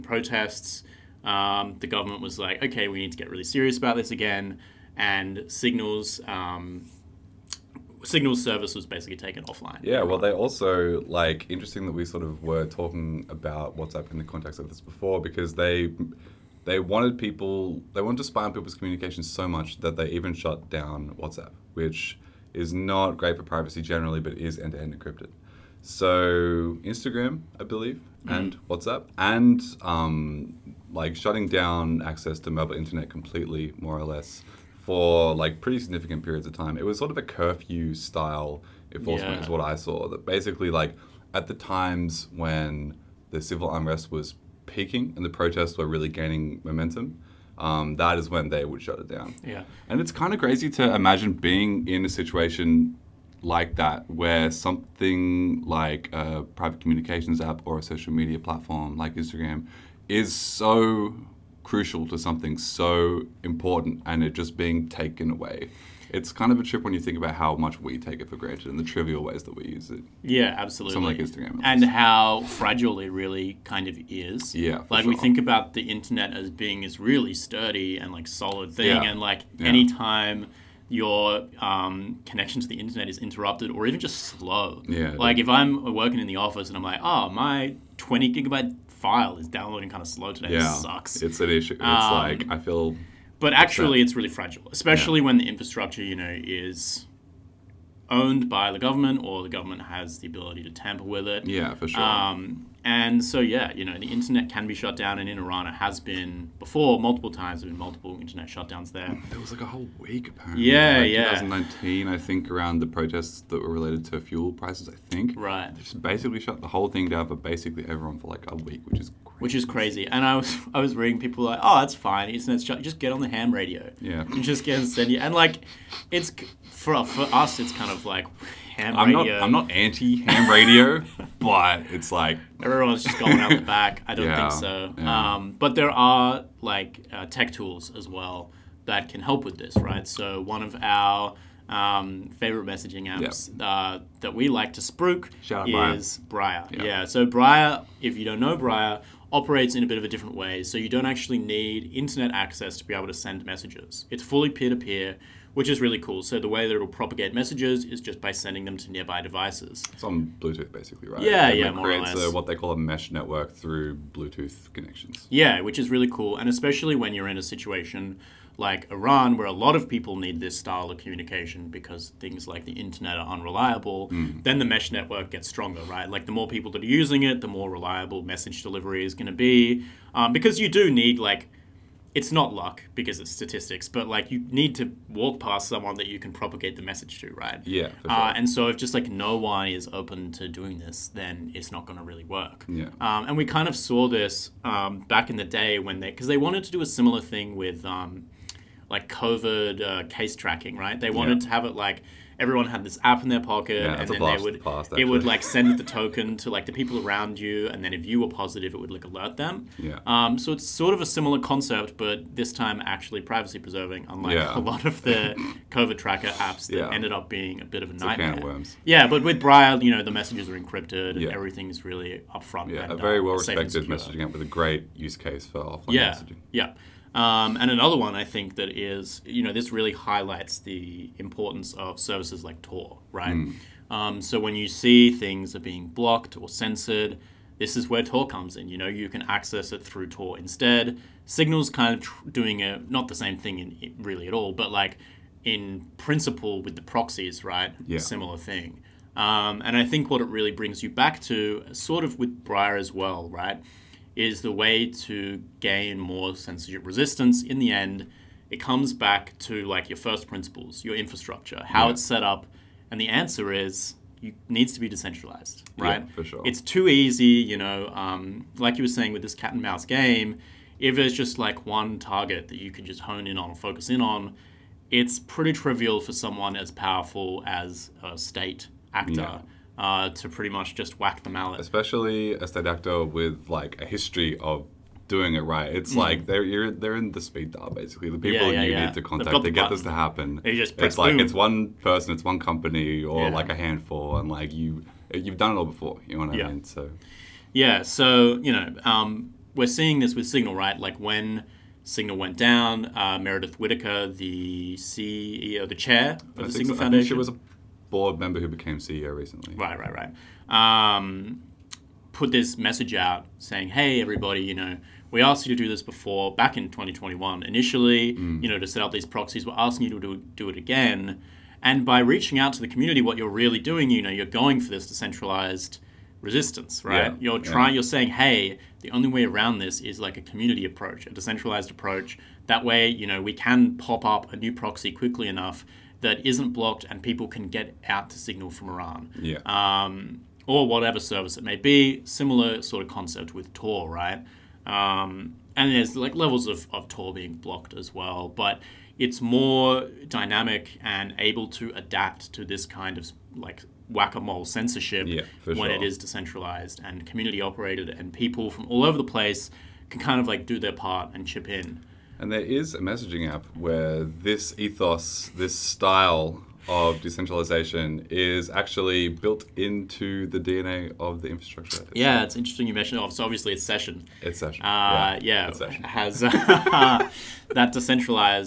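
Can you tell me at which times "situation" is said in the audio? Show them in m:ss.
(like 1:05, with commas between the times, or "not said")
0:52, 2:47.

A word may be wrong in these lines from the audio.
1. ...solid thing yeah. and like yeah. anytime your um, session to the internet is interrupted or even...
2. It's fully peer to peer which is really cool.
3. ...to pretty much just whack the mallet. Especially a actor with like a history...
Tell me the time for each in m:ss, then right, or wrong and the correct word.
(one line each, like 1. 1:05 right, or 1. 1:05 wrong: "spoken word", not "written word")
1. 1:18 wrong: "connection", not "session"
2. 2:34 right
3. 4:40 right.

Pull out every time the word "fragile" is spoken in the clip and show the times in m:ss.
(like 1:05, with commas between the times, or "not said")
1:12, 1:34.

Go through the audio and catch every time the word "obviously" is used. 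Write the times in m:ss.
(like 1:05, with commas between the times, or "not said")
6:13.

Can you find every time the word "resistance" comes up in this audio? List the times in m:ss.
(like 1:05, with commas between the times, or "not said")
4:16, 5:26.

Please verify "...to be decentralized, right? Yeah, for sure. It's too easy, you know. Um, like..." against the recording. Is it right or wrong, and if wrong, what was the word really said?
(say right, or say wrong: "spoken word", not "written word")
right.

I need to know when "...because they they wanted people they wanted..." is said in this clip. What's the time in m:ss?
0:15.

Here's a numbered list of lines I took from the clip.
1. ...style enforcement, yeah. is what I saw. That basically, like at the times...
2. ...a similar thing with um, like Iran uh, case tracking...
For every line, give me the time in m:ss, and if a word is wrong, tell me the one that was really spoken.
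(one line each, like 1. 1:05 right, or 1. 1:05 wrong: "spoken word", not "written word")
1. 0:37 right
2. 3:16 wrong: "COVID", not "Iran".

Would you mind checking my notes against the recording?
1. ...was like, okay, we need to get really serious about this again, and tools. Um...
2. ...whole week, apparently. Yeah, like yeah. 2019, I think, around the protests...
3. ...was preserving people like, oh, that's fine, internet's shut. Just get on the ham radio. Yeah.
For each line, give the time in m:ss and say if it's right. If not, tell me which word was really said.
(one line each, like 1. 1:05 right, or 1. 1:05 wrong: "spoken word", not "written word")
1. 0:02 wrong: "signals", not "tools"
2. 1:49 right
3. 2:00 wrong: "reading", not "preserving".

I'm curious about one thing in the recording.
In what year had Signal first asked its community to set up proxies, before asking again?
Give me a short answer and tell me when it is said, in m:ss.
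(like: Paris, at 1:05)
2021, at 5:16.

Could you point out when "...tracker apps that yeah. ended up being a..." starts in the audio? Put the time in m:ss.
3:35.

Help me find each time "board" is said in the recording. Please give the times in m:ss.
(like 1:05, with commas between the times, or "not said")
5:07.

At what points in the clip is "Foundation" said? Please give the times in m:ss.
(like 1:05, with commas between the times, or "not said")
5:06.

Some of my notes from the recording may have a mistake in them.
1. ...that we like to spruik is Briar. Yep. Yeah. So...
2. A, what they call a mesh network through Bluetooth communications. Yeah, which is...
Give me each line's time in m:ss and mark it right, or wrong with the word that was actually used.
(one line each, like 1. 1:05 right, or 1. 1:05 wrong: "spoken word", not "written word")
1. 2:24 right
2. 2:42 wrong: "connections", not "communications".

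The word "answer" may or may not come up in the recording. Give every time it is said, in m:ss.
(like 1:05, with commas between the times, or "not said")
4:23.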